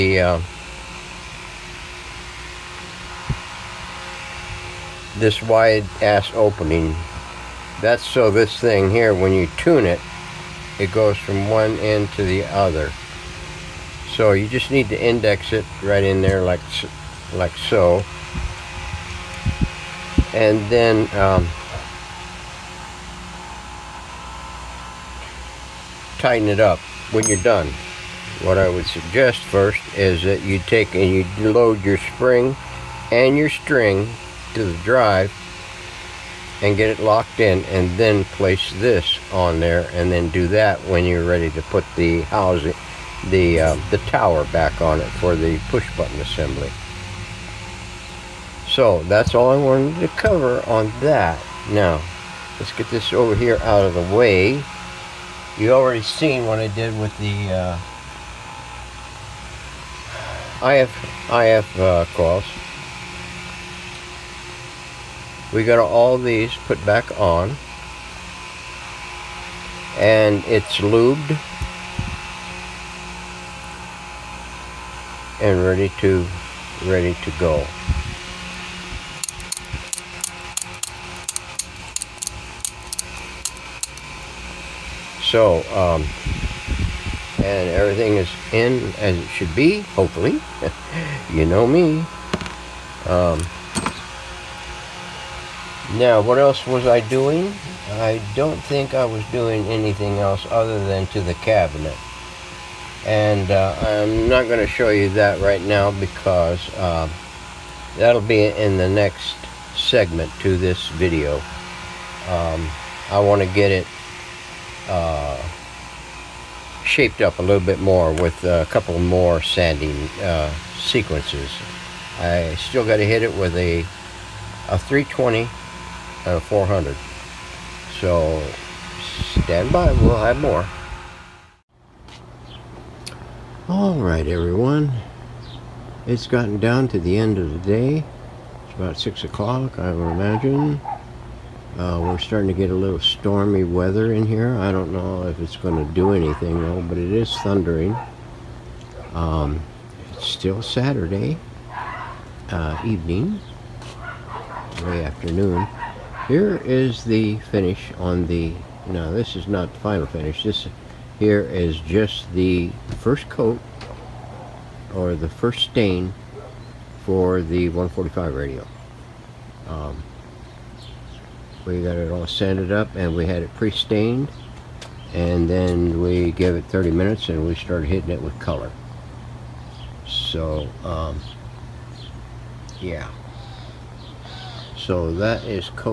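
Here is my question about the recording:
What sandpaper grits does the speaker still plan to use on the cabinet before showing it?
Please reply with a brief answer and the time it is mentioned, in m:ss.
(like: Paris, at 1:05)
320 and 400, at 2:04.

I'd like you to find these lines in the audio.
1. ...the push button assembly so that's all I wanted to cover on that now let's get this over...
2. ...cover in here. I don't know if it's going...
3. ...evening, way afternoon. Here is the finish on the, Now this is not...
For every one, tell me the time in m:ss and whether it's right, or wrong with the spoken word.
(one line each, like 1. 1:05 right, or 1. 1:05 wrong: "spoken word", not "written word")
1. 0:45 right
2. 2:23 wrong: "weather", not "cover"
3. 2:32 right.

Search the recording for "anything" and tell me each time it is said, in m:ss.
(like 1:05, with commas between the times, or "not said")
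1:39, 2:26.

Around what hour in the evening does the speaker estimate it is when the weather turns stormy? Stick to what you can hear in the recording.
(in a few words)
6 o'clock.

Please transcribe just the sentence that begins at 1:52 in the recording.
Um, I want to get it uh, shaped up a little bit more with a couple more sanding uh, sequences.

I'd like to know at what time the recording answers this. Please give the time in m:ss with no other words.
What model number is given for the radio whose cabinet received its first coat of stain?
2:47.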